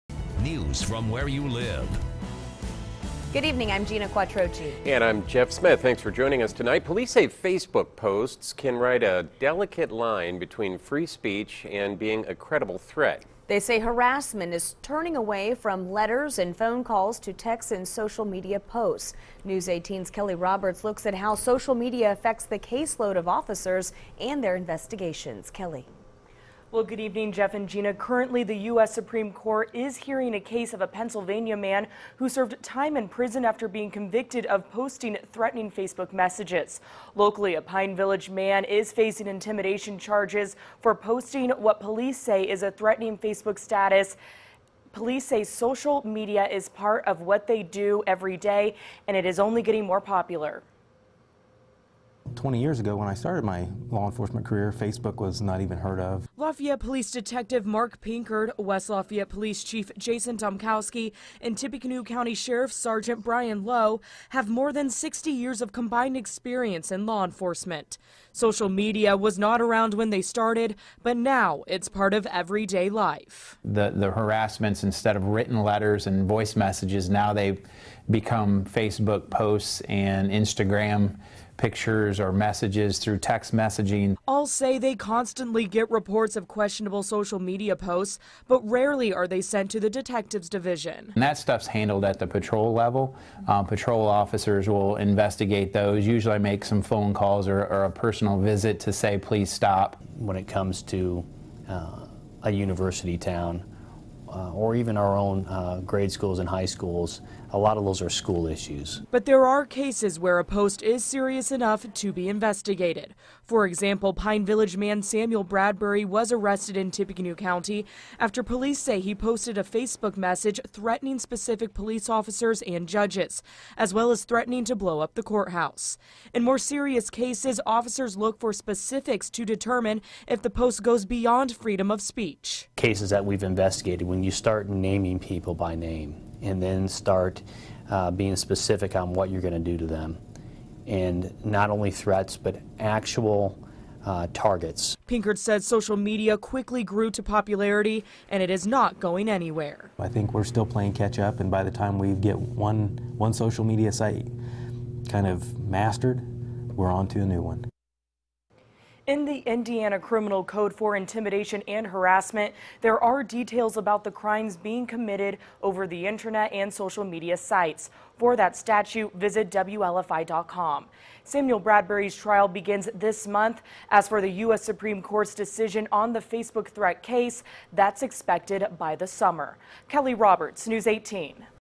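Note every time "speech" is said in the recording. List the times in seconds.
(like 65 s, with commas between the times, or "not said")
11 s, 132 s.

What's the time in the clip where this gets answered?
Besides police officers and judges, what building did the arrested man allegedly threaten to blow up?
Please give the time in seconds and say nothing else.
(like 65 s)
125 s.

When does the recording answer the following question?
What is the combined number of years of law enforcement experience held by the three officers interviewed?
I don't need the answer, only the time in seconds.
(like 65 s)
64 s.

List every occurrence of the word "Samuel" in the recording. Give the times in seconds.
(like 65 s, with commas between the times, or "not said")
115 s, 171 s.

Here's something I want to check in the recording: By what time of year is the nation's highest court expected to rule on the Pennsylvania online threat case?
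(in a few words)
summer.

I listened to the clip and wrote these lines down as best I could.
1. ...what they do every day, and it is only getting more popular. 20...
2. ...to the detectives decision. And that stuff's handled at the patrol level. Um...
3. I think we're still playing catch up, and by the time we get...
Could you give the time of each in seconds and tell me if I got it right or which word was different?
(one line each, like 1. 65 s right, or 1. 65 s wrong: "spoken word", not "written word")
1. 47 s right
2. 89 s wrong: "division", not "decision"
3. 149 s right.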